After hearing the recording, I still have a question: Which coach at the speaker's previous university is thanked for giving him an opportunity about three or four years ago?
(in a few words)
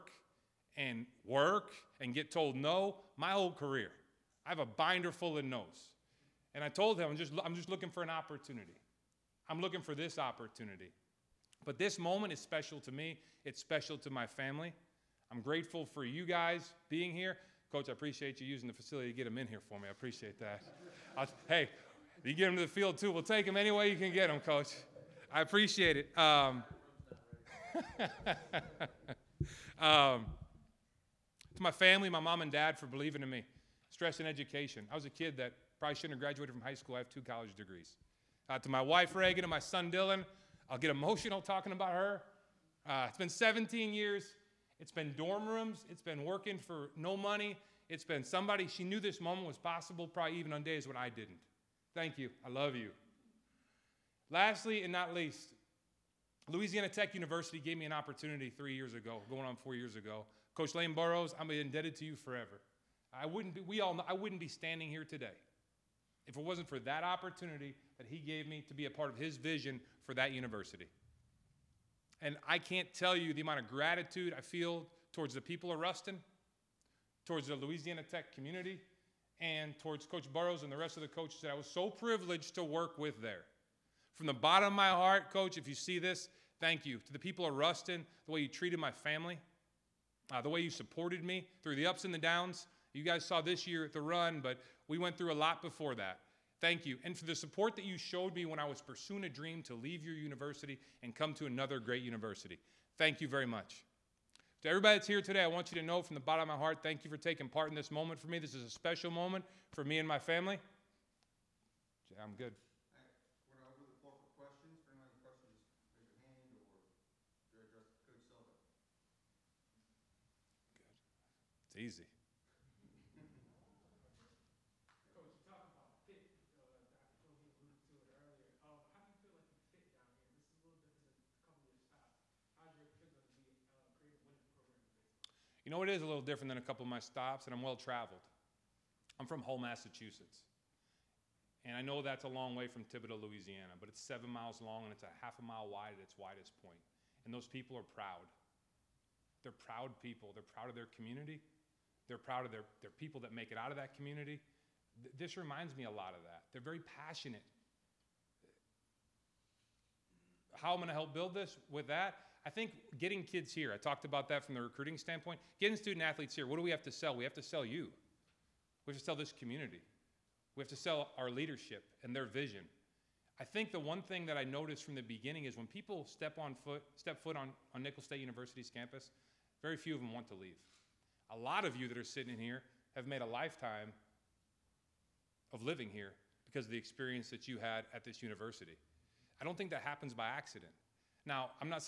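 Lane Burroughs.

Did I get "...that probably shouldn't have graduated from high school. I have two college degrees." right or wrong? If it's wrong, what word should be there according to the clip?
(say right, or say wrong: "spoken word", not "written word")
right.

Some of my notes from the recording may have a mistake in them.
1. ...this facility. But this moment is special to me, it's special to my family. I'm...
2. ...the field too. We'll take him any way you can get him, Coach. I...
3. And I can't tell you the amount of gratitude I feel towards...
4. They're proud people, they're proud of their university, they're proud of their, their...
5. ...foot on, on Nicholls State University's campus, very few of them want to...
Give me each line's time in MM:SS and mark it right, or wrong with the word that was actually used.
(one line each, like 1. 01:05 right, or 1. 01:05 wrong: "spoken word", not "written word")
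1. 00:09 wrong: "opportunity", not "facility"
2. 00:22 right
3. 01:12 right
4. 02:29 wrong: "community", not "university"
5. 02:57 right.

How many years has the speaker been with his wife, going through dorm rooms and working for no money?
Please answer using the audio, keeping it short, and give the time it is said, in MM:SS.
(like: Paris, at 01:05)
17, at 00:43.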